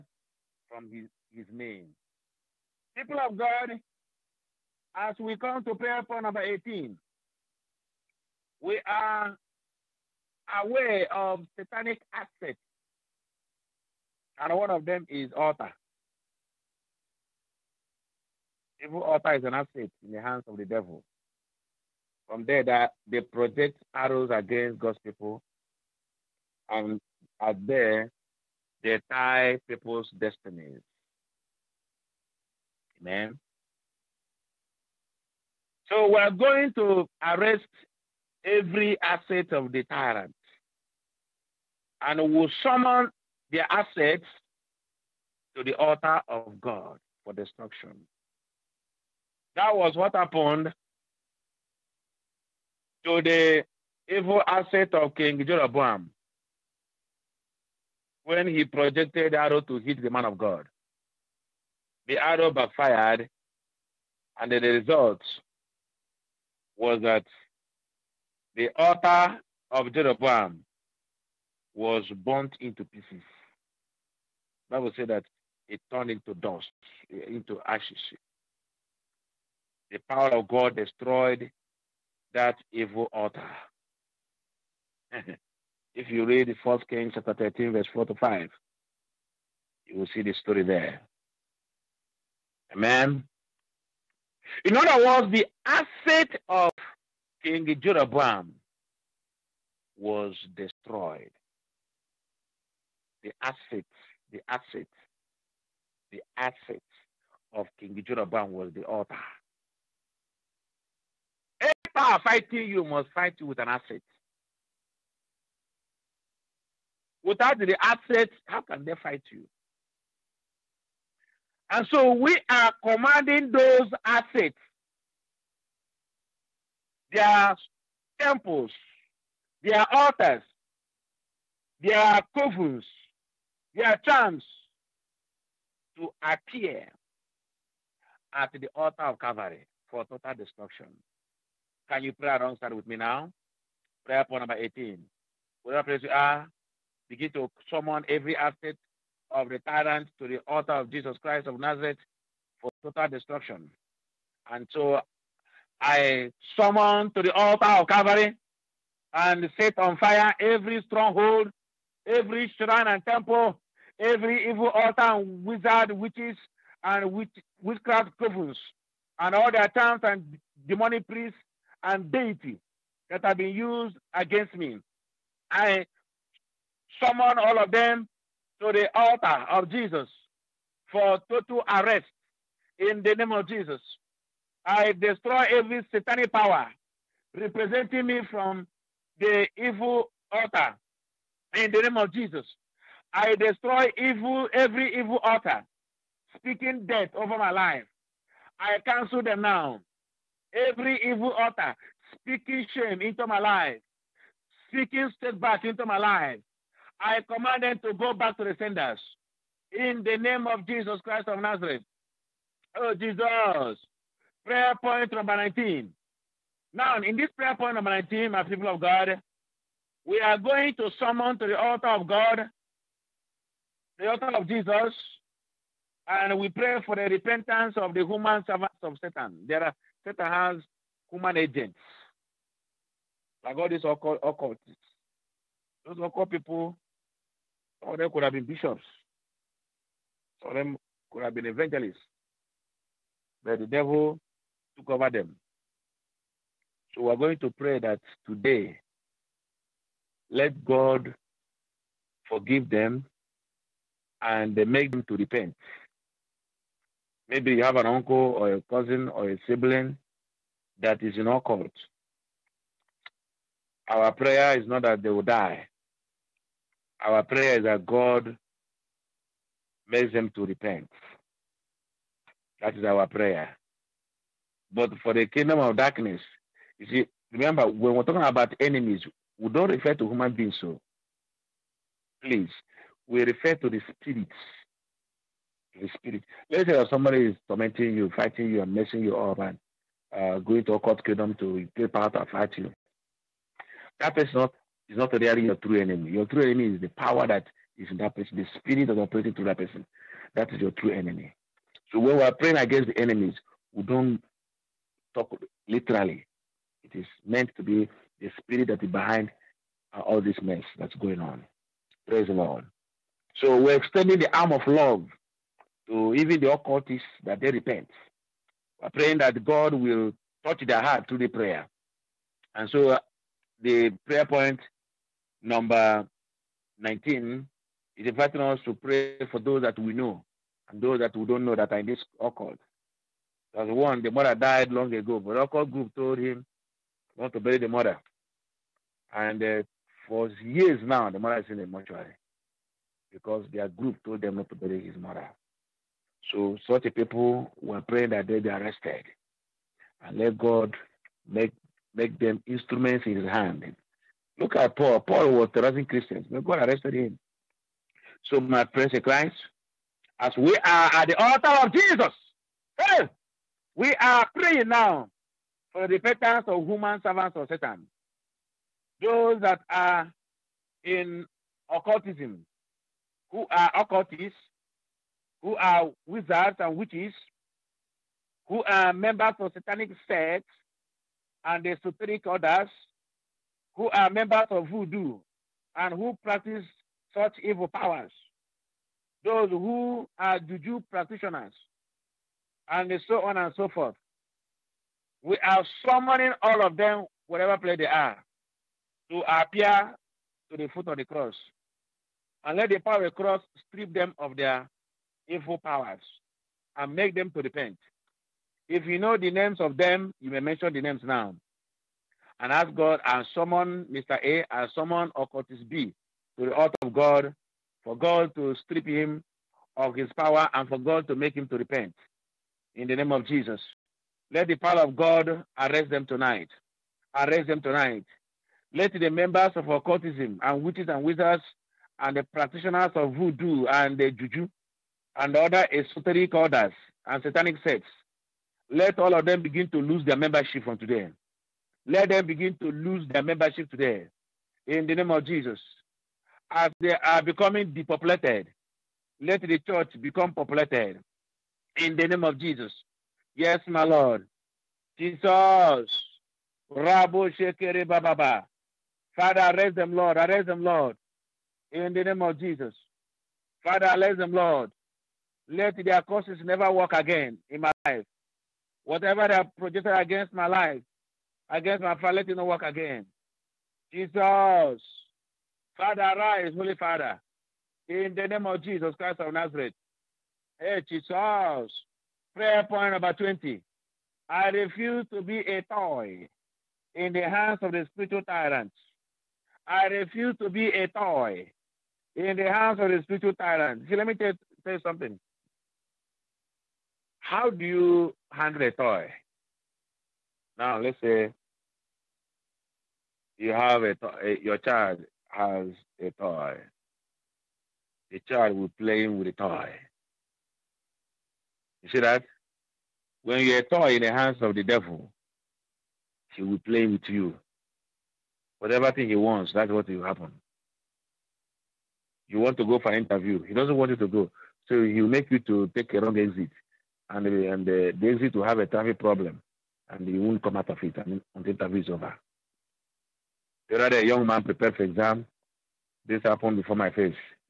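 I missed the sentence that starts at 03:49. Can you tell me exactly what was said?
There are Satan has human agents, like all these occult, occultists.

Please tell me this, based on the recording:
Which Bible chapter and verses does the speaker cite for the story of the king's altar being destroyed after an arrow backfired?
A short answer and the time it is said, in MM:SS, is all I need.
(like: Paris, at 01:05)
1 Kings 13:4-5, at 01:26.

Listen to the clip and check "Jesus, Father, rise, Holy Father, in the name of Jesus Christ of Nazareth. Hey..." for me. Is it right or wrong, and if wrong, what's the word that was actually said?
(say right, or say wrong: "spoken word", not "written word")
right.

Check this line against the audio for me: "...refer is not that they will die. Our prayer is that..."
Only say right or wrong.
wrong.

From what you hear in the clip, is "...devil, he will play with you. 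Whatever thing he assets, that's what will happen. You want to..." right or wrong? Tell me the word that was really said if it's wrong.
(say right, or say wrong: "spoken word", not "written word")
wrong: "wants", not "assets".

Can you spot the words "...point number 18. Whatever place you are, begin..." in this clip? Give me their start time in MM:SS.
02:24.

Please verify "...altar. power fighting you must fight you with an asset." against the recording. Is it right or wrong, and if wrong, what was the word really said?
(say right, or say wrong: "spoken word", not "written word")
right.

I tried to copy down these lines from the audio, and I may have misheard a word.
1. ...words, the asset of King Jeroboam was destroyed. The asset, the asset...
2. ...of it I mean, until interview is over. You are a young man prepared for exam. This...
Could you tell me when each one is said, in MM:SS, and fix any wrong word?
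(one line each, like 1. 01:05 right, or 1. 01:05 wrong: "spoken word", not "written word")
1. 01:35 right
2. 08:50 right.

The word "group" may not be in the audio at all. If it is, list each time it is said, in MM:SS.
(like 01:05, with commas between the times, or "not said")
05:35, 05:43.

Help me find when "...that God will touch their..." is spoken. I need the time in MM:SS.
05:19.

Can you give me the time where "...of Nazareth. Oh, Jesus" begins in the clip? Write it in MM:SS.
03:31.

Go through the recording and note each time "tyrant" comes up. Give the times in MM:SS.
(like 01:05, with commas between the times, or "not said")
00:39, 02:29, 08:08, 08:13.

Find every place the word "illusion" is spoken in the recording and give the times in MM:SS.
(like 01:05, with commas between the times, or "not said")
not said.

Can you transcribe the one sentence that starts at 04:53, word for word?
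That person is not, is not really your true enemy.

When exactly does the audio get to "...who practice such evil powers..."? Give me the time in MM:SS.
06:25.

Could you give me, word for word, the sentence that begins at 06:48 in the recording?
If you know the names of them, you may mention the names now.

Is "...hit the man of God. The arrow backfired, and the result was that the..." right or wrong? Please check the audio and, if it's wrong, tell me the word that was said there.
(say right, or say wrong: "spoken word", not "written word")
right.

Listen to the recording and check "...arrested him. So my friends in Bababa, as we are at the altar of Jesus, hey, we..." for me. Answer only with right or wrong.
wrong.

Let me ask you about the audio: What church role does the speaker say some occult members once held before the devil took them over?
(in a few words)
Bishops.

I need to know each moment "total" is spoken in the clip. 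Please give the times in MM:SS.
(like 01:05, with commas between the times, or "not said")
02:20, 02:32, 03:01.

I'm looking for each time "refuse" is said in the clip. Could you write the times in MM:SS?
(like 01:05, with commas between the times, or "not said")
08:04, 08:09.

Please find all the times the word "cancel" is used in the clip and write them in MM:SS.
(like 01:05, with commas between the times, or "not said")
03:18.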